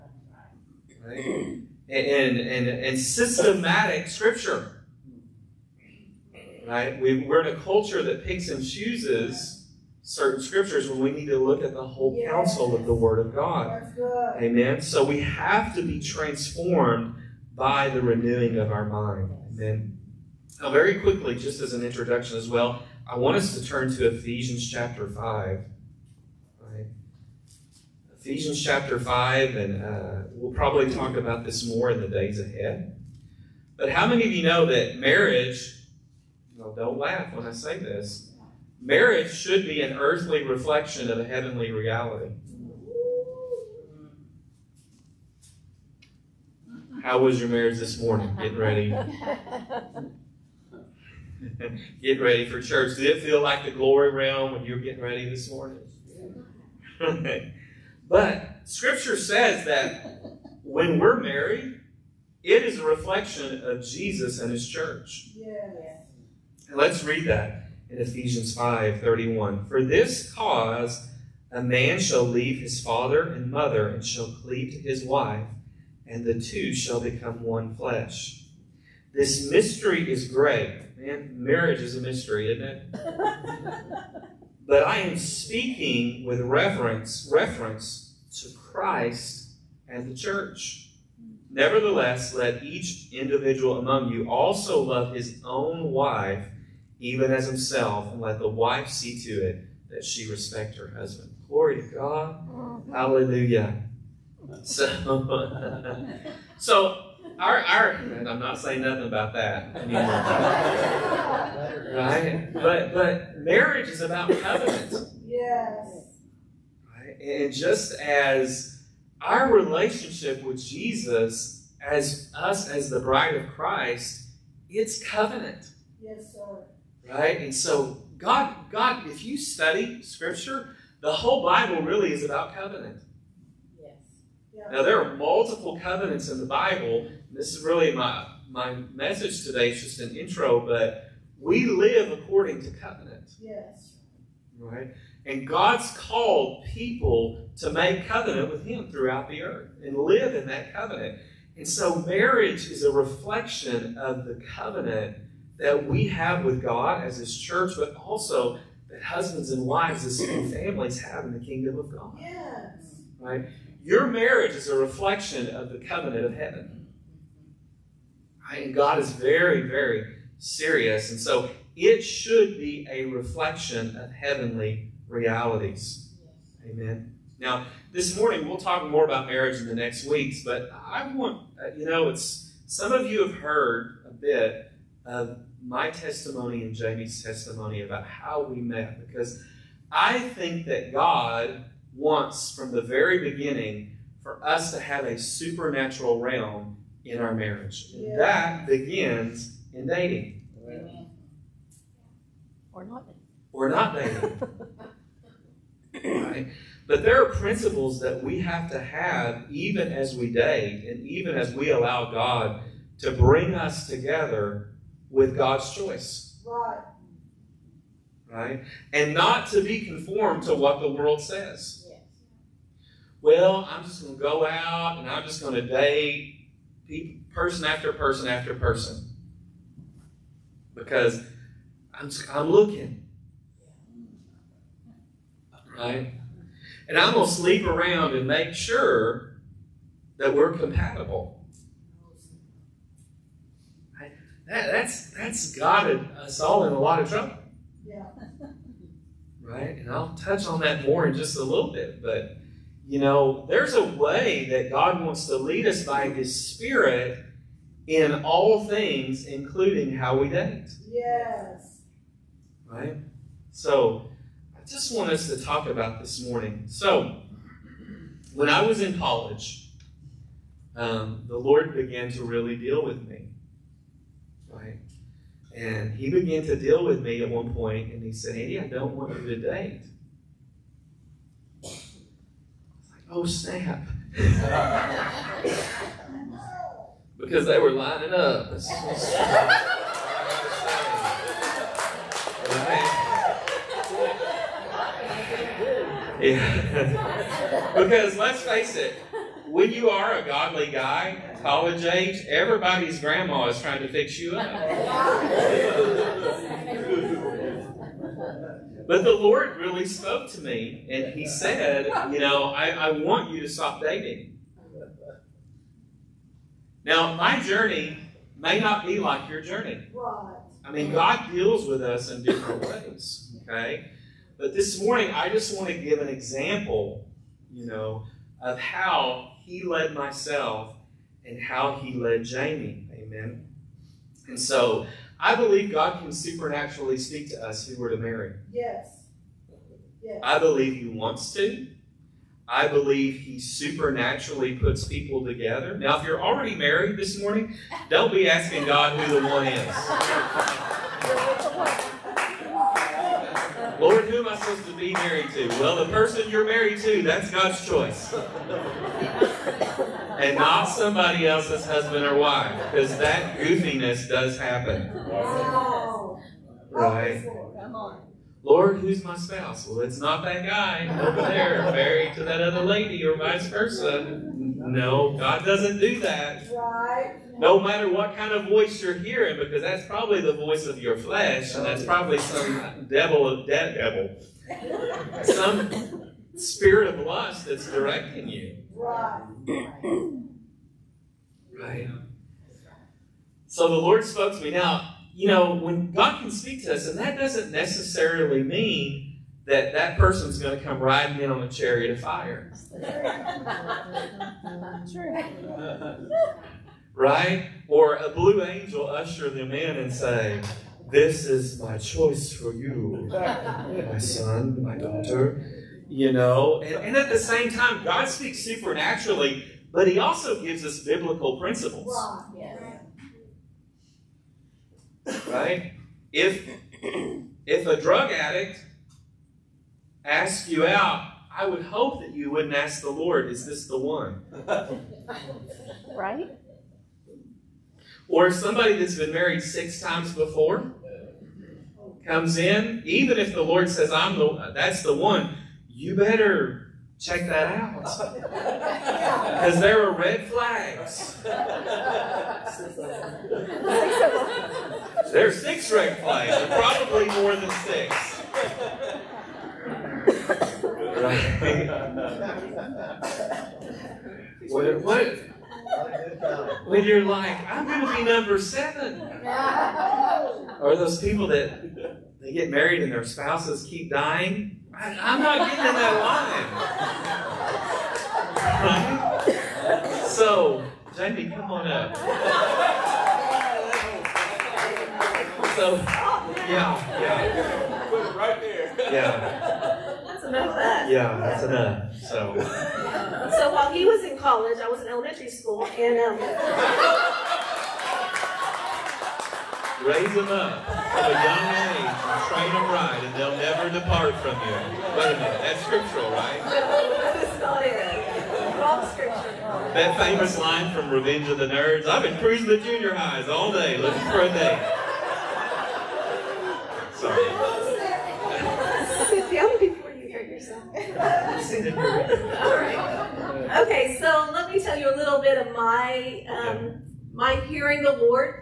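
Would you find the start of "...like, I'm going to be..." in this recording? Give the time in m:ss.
7:47.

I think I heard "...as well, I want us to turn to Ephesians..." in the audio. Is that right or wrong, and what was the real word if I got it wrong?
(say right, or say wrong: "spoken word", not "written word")
right.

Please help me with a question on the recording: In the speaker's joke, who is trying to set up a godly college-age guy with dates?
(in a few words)
Everybody's grandma.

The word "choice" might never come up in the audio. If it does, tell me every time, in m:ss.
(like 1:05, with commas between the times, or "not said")
3:35, 5:57, 6:51.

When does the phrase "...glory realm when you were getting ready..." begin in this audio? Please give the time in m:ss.
0:53.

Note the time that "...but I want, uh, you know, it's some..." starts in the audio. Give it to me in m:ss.
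3:00.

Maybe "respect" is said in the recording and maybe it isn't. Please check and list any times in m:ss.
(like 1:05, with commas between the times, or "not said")
1:40.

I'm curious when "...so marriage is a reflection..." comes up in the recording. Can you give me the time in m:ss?
2:31.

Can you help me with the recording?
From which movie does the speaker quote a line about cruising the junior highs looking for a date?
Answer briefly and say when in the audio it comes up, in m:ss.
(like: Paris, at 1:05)
Revenge of the Nerds, at 8:30.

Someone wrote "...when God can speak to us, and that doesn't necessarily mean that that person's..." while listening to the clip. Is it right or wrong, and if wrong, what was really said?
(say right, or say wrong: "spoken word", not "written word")
right.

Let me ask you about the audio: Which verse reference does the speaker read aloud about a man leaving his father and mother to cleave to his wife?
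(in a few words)
Ephesians 5:31.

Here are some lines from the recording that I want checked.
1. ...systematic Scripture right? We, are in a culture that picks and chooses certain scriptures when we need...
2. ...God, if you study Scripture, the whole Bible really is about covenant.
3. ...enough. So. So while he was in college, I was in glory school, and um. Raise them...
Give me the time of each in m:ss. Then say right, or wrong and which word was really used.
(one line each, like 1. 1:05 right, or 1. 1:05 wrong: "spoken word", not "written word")
1. 0:02 right
2. 2:08 right
3. 8:11 wrong: "elementary", not "glory".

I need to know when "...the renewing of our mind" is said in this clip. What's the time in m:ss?
0:17.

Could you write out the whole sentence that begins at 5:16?
Now, my journey may not be like your journey.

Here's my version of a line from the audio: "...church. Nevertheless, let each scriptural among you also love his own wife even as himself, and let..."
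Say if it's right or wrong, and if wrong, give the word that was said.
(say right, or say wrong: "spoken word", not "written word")
wrong: "individual", not "scriptural".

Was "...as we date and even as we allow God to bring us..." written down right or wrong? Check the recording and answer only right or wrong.
right.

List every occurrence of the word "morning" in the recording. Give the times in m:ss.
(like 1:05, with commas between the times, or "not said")
0:47, 0:55, 2:58, 4:26, 5:24, 5:47.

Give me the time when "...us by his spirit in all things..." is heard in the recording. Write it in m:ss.
4:15.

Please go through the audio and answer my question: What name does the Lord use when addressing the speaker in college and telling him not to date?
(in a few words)
Andy.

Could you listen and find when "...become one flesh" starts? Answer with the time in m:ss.
1:16.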